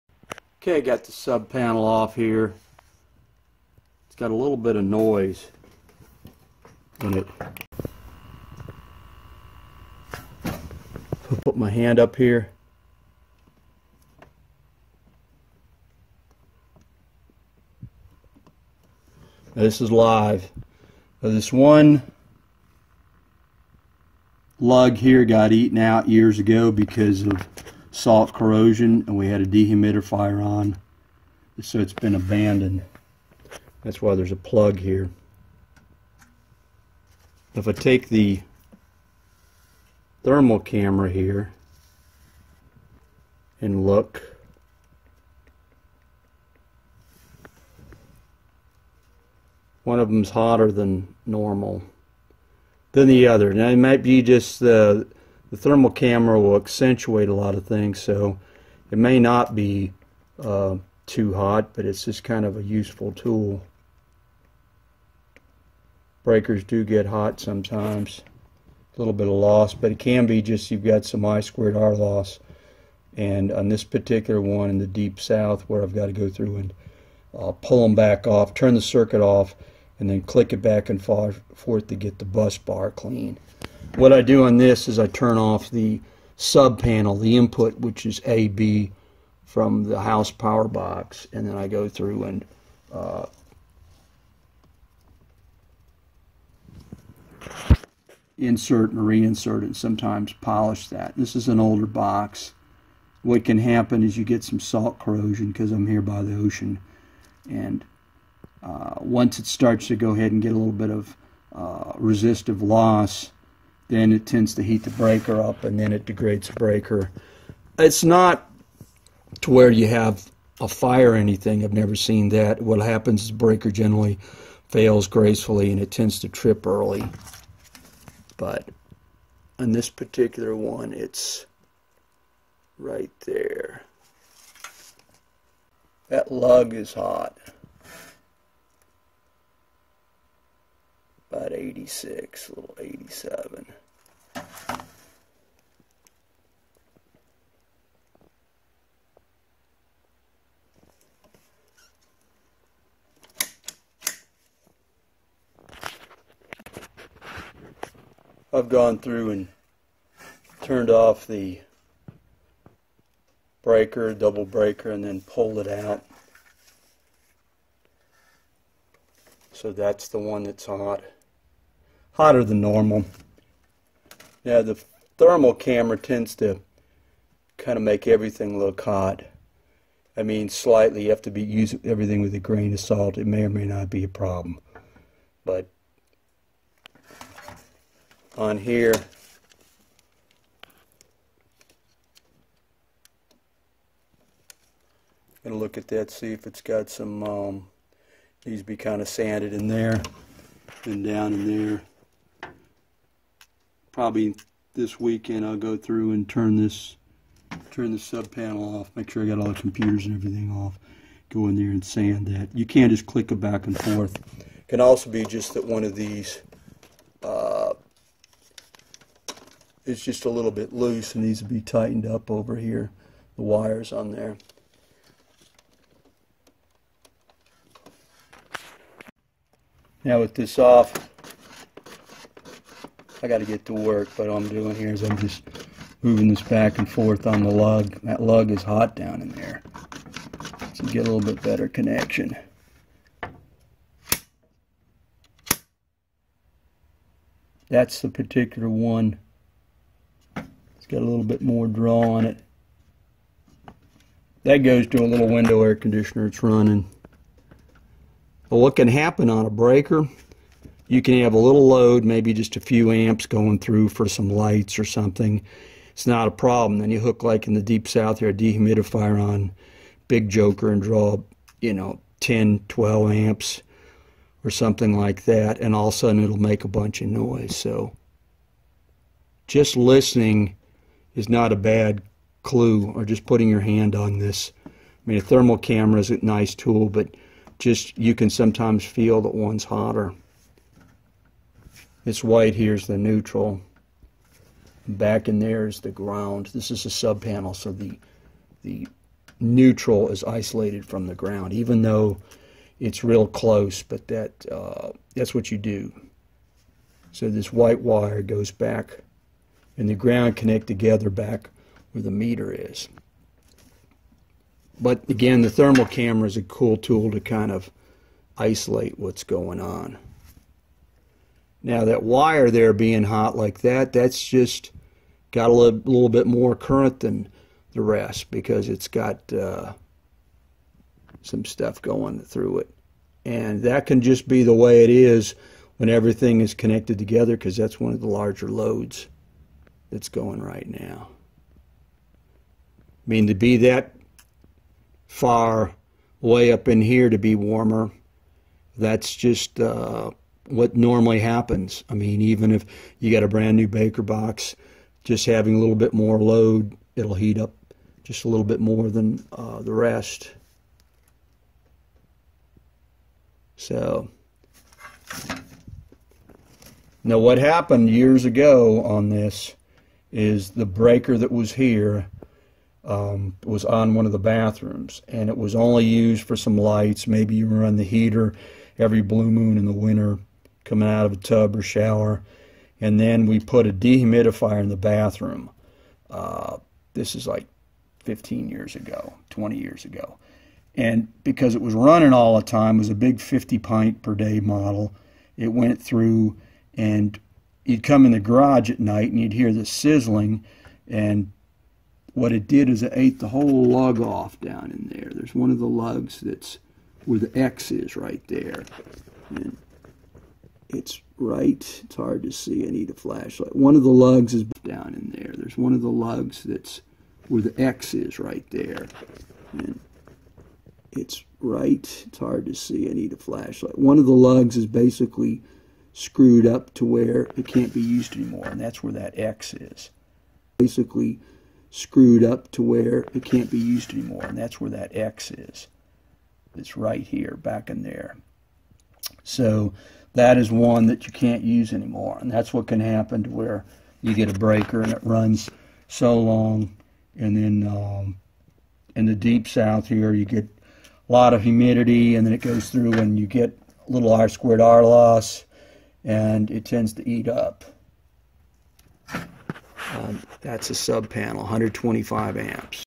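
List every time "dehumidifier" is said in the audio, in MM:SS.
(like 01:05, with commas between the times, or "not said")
00:29, 04:28, 06:23.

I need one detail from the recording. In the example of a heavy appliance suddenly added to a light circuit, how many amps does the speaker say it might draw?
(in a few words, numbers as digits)
10, 12 amps.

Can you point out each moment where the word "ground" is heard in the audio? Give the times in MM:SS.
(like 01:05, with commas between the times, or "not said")
04:55, 05:01, 05:09.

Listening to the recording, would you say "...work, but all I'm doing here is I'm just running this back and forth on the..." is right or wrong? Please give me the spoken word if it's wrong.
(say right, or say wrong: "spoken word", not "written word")
wrong: "moving", not "running".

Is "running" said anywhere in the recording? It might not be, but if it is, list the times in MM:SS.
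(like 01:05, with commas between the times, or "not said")
04:16, 06:31.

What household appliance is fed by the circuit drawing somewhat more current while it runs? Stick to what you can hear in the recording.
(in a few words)
Window air conditioner.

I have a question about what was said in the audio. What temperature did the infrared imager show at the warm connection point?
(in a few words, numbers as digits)
86.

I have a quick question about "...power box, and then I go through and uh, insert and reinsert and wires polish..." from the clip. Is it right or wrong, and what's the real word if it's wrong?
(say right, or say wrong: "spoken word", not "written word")
wrong: "sometimes", not "wires".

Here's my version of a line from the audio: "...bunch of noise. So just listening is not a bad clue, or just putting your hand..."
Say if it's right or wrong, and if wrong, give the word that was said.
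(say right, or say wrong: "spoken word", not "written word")
right.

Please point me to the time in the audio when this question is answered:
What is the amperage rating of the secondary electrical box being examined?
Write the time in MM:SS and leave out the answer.
07:41.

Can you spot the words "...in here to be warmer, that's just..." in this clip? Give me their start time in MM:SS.
05:46.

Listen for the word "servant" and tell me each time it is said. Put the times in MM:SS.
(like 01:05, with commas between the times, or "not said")
not said.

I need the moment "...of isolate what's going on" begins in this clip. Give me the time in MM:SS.
05:17.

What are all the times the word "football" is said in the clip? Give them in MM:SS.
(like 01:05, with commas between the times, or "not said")
not said.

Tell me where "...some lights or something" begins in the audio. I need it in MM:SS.
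04:24.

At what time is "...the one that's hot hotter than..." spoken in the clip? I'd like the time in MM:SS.
02:50.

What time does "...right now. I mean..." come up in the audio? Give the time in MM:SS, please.
05:40.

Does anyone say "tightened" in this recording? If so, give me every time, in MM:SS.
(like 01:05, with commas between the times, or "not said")
03:41.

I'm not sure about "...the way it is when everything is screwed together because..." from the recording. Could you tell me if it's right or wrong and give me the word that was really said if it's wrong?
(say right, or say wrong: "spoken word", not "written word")
wrong: "connected", not "screwed".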